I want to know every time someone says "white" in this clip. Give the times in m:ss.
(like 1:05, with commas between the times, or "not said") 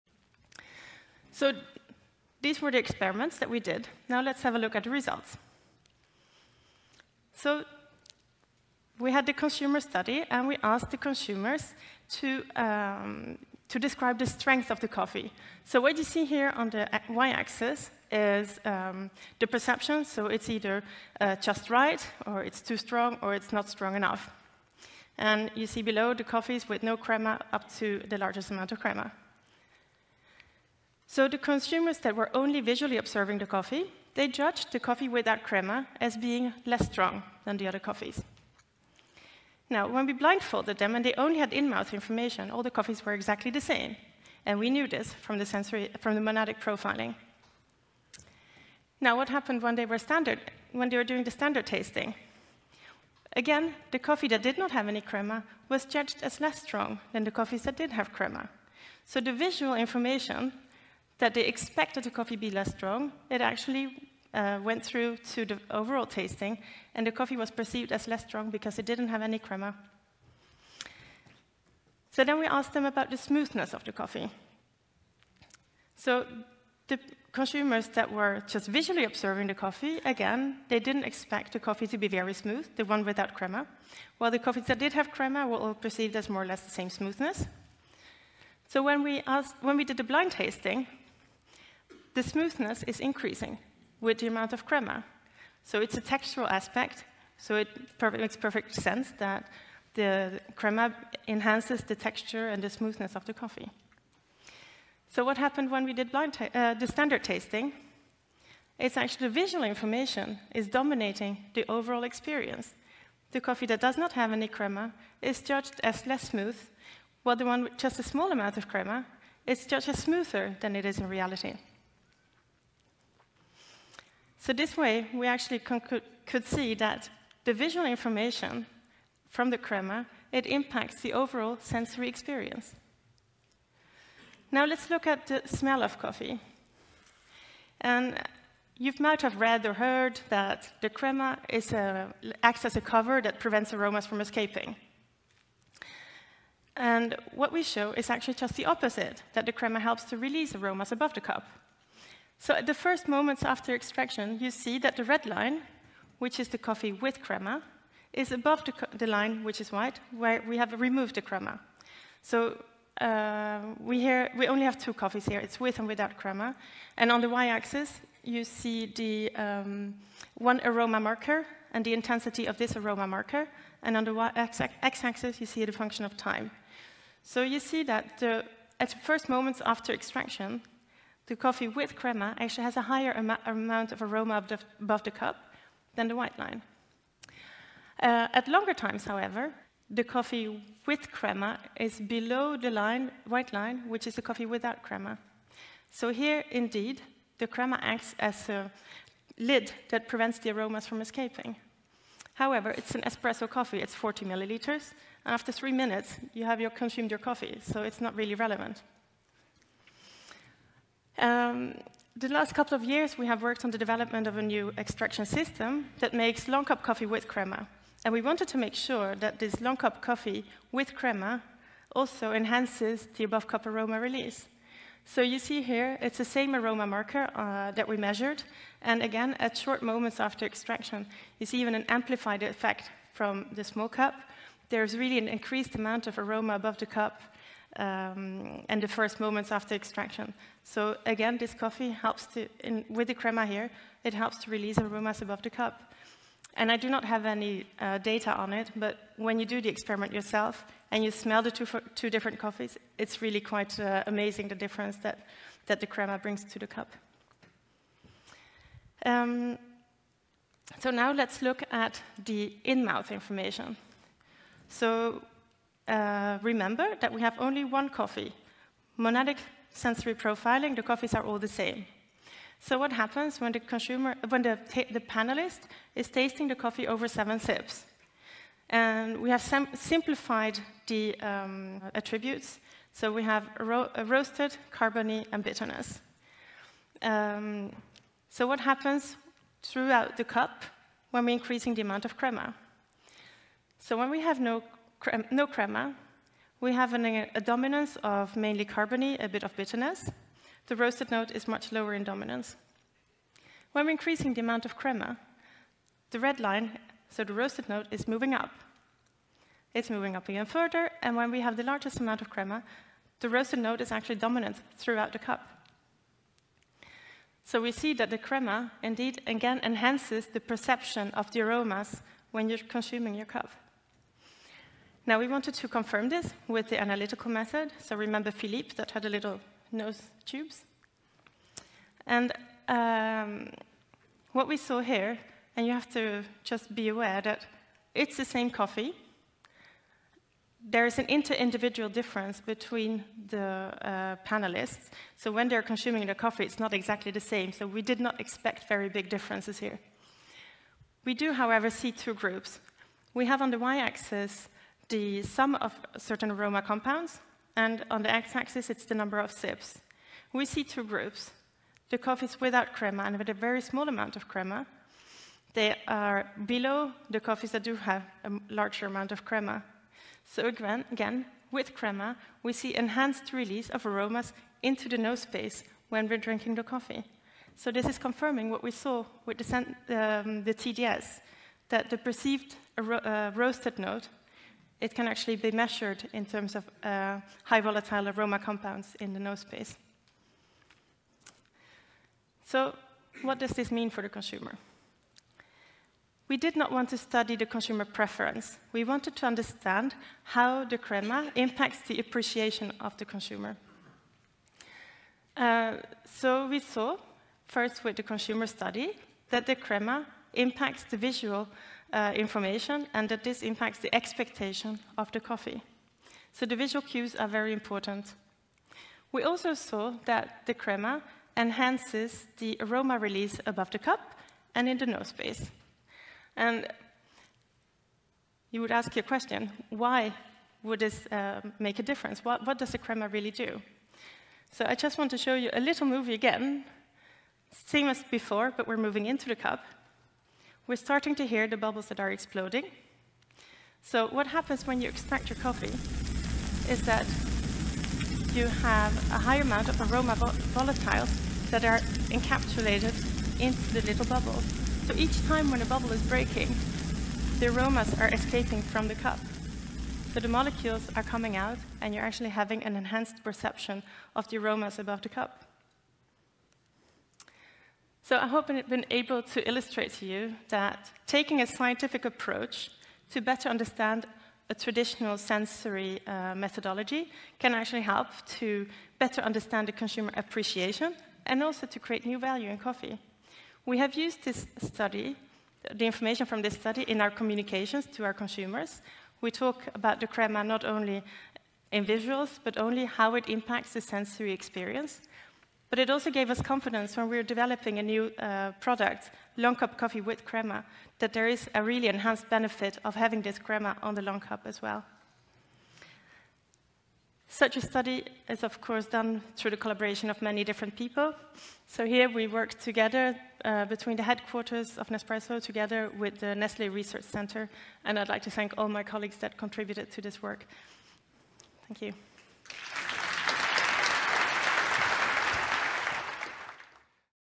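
2:39, 3:06, 3:13.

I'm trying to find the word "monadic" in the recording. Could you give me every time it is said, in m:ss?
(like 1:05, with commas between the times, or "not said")
0:46, 4:28.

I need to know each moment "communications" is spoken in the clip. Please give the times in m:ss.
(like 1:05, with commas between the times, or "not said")
8:07.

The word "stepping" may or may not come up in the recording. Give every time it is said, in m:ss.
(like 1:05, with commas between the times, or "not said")
not said.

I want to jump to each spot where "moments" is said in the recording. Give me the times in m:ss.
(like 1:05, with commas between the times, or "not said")
2:33, 2:59, 3:49, 3:59.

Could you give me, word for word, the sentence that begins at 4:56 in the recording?
We have an, uh, a dominance of mainly carbony, a bit of bitterness.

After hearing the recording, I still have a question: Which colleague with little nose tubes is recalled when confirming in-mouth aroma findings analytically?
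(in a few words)
Philippe.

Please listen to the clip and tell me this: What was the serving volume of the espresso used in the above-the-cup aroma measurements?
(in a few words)
40 milliliters.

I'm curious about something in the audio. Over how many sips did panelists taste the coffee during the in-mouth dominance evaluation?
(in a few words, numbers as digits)
7.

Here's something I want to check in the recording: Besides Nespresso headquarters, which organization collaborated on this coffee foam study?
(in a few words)
Nestle Research Center.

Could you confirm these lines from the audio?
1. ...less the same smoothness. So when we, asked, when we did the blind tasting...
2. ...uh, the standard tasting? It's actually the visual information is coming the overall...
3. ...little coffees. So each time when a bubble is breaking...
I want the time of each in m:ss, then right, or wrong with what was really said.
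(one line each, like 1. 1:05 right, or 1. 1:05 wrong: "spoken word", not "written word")
1. 1:26 right
2. 1:46 wrong: "dominating", not "coming"
3. 7:33 wrong: "bubbles", not "coffees".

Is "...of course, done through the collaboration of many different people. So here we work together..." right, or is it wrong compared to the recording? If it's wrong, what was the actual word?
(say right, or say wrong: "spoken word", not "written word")
right.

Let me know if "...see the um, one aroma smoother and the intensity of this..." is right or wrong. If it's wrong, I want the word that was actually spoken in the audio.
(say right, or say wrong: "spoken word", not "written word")
wrong: "marker", not "smoother".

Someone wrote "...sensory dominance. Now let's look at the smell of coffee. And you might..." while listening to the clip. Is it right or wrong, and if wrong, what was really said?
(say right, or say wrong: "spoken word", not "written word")
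wrong: "experience", not "dominance".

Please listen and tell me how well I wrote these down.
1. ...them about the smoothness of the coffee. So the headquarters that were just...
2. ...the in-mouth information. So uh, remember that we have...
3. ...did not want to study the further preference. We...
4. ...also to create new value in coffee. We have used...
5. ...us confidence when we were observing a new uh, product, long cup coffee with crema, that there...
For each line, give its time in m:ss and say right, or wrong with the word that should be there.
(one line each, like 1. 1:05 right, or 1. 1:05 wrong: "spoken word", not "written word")
1. 1:12 wrong: "consumers", not "headquarters"
2. 4:22 right
3. 6:36 wrong: "consumer", not "further"
4. 8:01 right
5. 8:16 wrong: "developing", not "observing".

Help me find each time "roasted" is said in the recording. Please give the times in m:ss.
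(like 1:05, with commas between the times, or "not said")
4:44, 5:00, 5:07, 5:13, 6:23.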